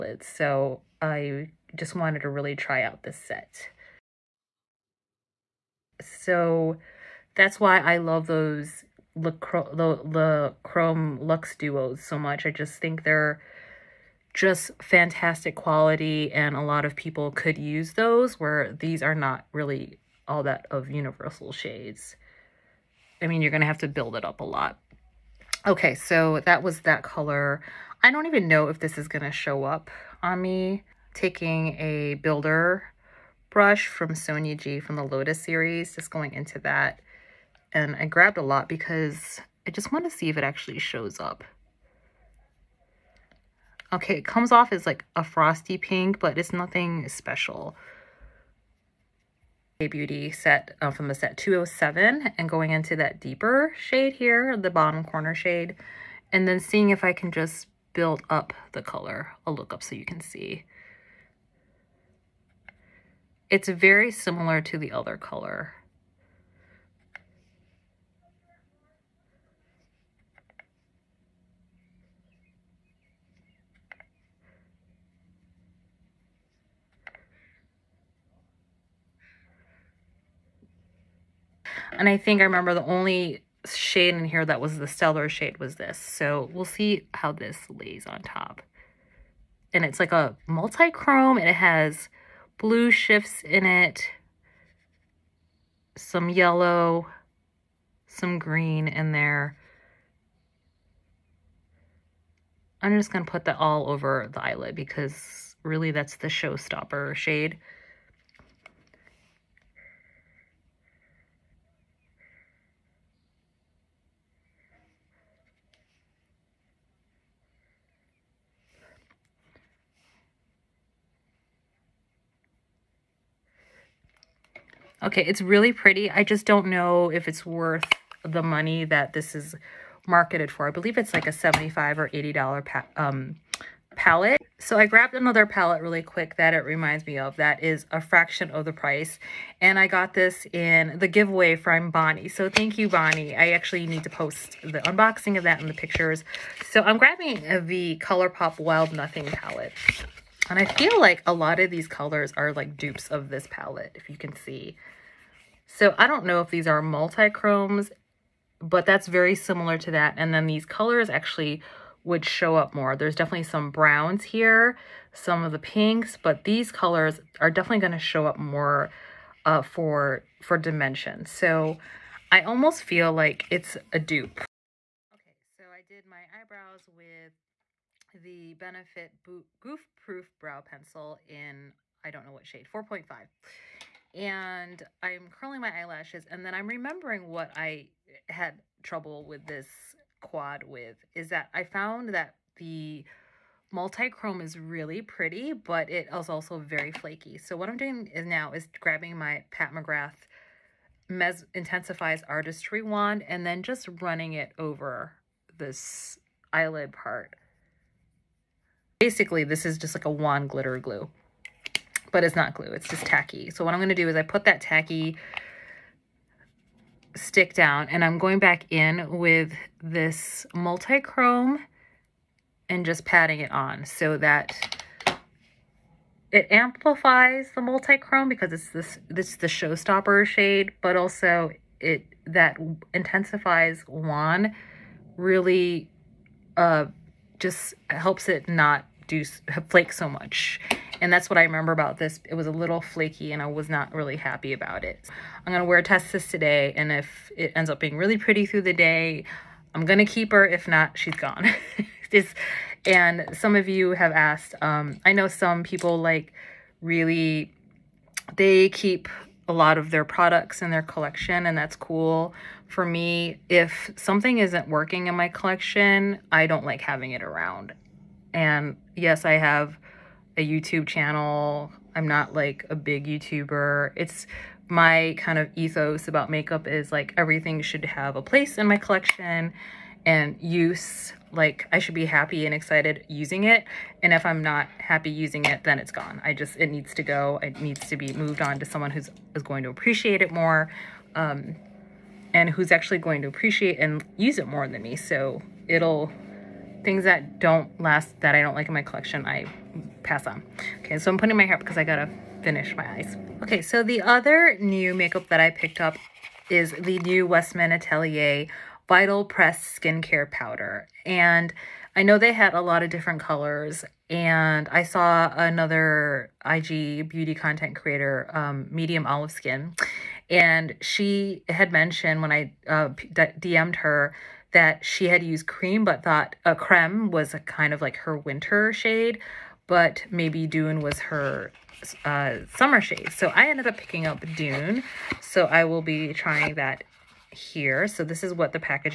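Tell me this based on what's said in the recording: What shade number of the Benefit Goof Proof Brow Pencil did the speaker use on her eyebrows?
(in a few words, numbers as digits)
4.5.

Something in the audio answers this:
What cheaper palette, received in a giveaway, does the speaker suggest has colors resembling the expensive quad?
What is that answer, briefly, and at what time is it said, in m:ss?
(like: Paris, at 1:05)
ColourPop Wild Nothing, at 2:27.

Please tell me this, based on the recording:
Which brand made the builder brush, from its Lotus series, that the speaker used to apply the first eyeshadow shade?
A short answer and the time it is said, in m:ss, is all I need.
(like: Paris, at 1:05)
Sonia G, at 0:34.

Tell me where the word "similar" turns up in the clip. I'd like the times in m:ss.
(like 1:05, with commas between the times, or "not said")
1:04, 2:39.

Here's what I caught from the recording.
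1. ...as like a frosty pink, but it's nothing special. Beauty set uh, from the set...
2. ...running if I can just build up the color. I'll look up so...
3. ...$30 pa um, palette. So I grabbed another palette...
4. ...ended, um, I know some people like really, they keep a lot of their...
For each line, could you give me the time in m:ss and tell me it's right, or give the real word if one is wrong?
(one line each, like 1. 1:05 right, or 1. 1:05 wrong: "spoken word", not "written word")
1. 0:44 right
2. 0:56 wrong: "seeing", not "running"
3. 2:12 wrong: "80", not "30"
4. 4:14 wrong: "asked", not "ended".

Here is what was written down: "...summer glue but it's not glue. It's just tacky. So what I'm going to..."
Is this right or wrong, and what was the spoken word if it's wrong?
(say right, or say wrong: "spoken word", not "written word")
wrong: "glitter", not "summer".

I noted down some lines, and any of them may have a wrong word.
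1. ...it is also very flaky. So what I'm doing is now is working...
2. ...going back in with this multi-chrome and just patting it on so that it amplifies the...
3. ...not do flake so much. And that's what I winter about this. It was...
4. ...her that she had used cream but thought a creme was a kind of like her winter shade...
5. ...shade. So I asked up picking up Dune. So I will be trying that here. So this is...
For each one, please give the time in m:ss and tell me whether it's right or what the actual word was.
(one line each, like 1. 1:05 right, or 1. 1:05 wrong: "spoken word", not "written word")
1. 3:15 wrong: "grabbing", not "working"
2. 3:38 right
3. 3:58 wrong: "remember", not "winter"
4. 5:23 right
5. 5:32 wrong: "ended", not "asked".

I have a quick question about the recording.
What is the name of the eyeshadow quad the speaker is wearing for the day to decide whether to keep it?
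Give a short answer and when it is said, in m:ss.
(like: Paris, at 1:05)
Tessa's, at 4:05.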